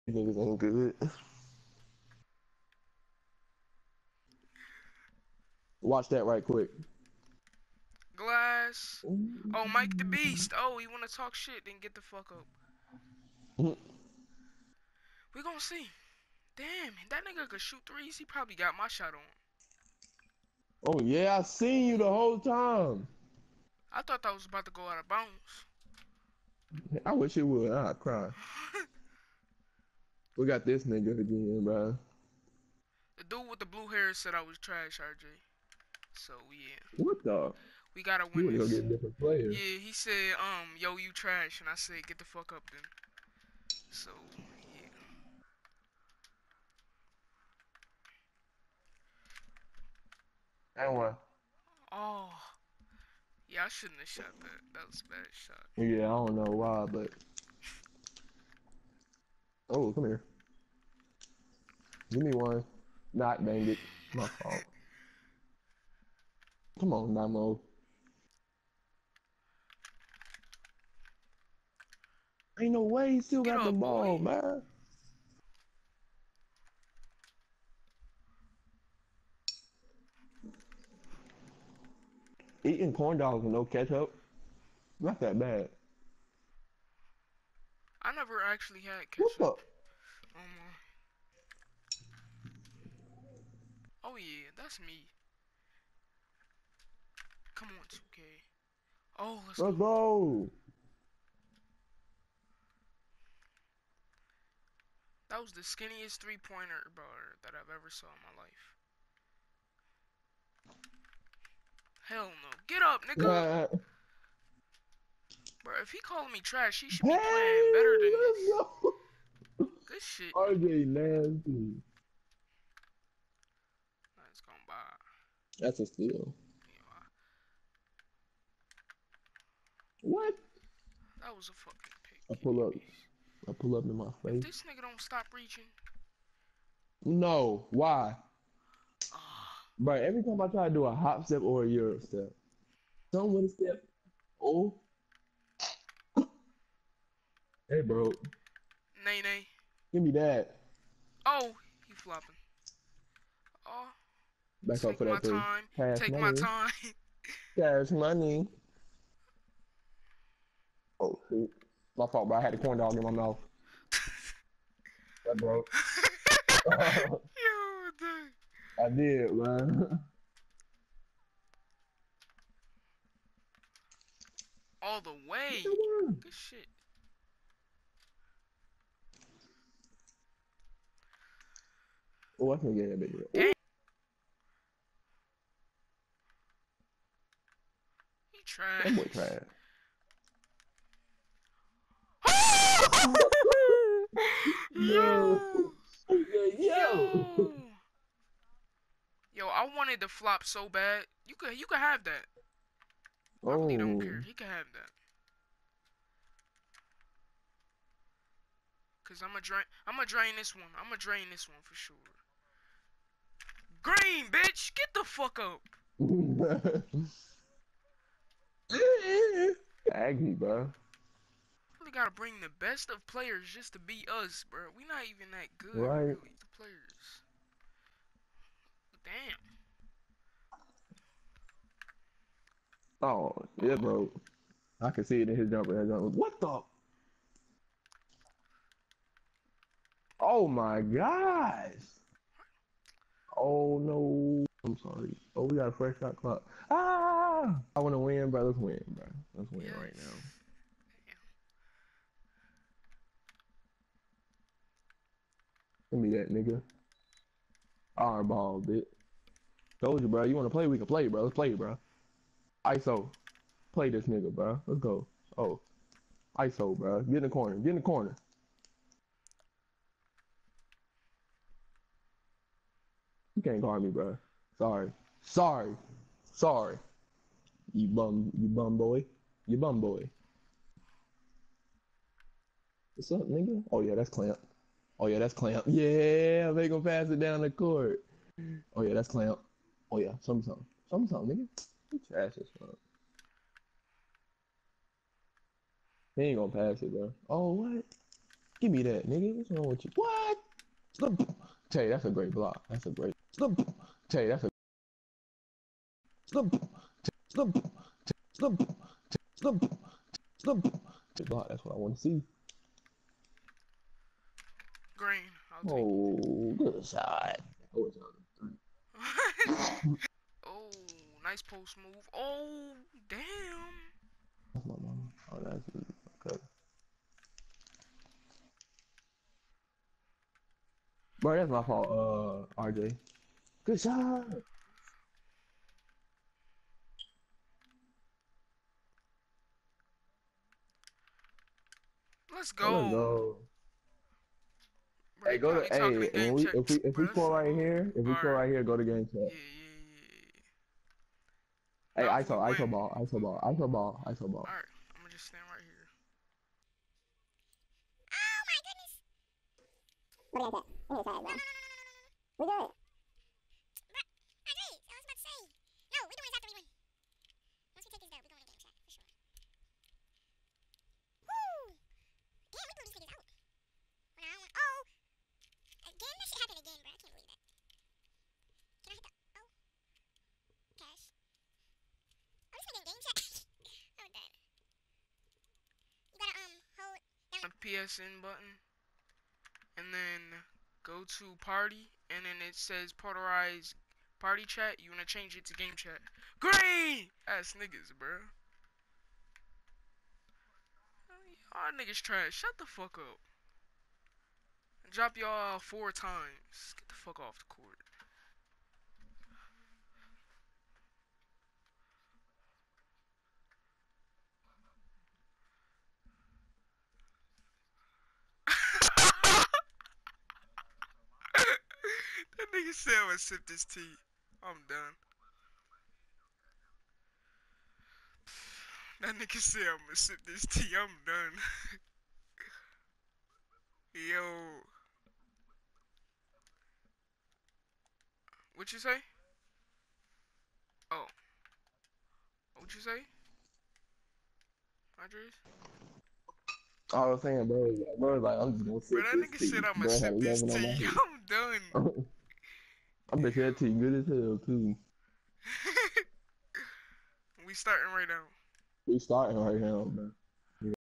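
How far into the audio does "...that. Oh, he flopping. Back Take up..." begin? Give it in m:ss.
2:30.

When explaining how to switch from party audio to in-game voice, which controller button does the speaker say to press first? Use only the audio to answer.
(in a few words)
PSN button.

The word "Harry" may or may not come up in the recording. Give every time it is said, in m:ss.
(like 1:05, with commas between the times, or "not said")
not said.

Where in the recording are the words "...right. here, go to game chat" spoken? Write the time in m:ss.
5:48.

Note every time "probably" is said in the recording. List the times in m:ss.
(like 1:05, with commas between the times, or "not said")
0:18.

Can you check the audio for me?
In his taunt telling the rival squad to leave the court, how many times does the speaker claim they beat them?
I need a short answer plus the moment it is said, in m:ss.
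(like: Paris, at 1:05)
4, at 6:45.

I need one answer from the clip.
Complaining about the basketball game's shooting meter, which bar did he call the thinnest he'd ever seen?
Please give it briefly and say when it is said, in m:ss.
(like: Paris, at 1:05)
three-pointer bar, at 1:46.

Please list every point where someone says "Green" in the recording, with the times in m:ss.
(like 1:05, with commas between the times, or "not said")
3:33, 5:14, 6:36.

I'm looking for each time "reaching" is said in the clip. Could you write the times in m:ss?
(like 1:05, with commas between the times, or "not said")
2:15.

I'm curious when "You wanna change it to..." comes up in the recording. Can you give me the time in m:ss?
6:34.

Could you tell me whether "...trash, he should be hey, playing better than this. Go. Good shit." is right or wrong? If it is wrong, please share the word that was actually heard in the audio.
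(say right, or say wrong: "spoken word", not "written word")
right.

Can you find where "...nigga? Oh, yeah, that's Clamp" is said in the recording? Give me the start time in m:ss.
4:43.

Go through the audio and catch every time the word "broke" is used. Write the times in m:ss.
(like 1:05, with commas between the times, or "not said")
2:45.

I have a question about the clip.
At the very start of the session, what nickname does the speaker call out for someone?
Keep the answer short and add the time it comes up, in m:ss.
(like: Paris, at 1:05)
Mike the Beast, at 0:09.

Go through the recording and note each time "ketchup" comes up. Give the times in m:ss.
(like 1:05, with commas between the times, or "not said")
1:23, 1:29.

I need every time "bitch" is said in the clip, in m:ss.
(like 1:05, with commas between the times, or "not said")
3:03, 3:34, 4:18.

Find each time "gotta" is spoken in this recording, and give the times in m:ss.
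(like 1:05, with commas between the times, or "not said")
0:38, 3:41.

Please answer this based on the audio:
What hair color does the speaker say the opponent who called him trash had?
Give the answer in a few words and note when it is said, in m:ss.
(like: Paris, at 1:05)
Blue, at 0:33.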